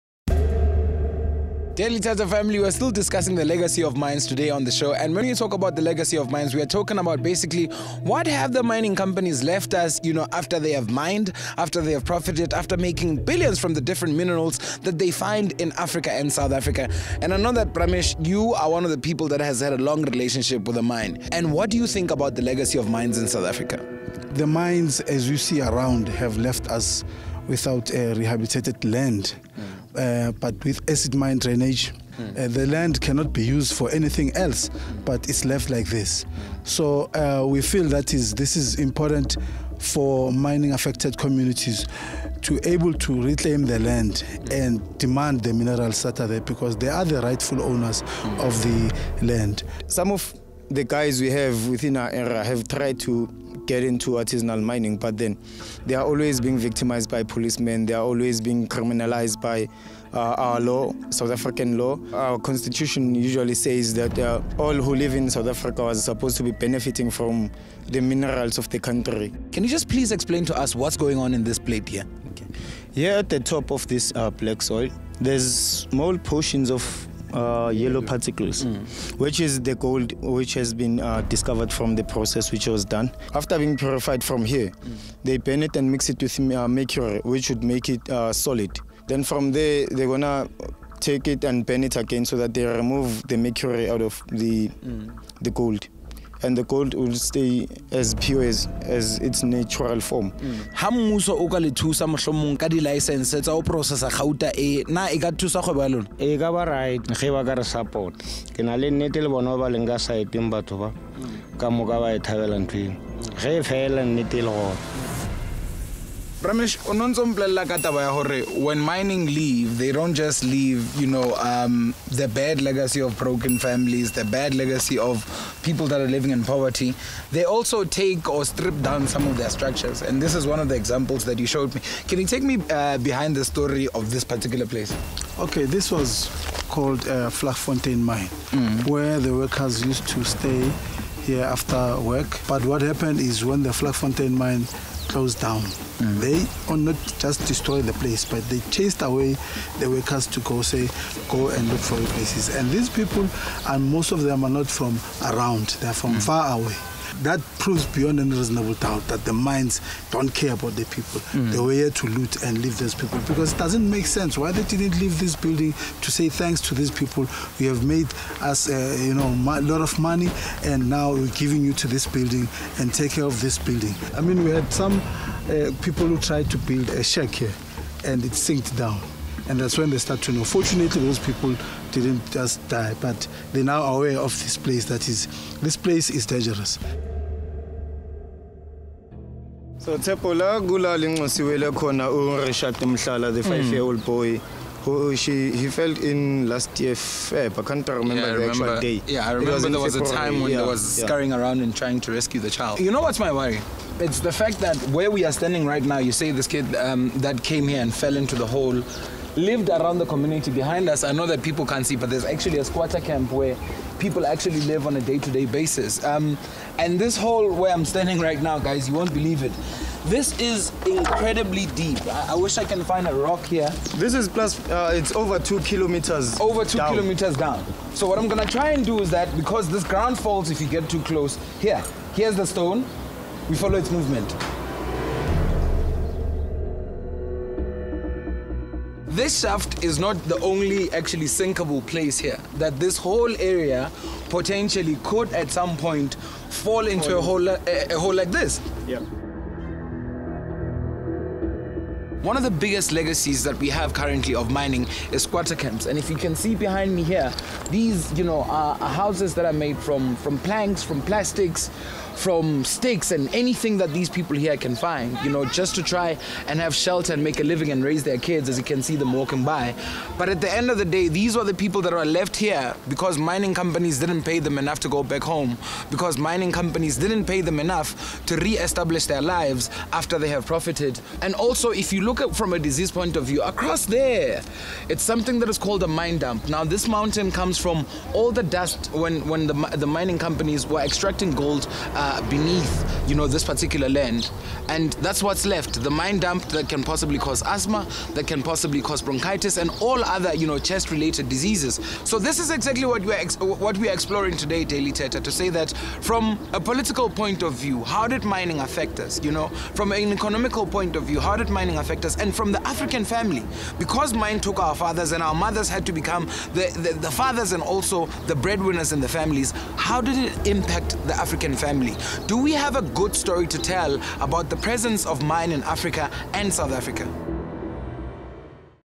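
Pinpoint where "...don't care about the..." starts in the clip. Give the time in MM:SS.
02:40.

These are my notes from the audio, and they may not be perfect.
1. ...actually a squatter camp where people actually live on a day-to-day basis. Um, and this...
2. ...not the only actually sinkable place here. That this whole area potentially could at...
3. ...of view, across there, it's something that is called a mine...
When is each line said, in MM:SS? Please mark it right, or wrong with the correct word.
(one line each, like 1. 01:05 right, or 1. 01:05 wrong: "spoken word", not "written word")
1. 03:32 right
2. 03:59 right
3. 04:43 right.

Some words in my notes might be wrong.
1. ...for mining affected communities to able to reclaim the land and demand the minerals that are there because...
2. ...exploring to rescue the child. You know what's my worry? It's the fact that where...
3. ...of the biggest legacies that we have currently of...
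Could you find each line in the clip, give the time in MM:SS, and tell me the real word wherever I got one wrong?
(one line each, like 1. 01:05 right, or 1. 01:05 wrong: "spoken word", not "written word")
1. 00:39 right
2. 03:21 wrong: "trying", not "exploring"
3. 04:12 right.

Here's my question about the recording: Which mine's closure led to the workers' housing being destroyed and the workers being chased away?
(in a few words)
Vlakfontein.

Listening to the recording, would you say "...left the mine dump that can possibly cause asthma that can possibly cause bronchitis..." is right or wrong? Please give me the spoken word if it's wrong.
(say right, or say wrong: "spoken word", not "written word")
right.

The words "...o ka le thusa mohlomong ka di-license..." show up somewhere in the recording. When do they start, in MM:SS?
01:41.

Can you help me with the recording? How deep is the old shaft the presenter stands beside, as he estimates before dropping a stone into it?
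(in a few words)
over 2 kilometers.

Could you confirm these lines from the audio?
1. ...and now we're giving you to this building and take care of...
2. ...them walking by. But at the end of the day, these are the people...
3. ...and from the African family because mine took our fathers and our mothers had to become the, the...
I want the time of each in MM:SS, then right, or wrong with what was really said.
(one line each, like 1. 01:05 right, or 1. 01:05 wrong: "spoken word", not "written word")
1. 02:50 right
2. 04:28 right
3. 05:12 right.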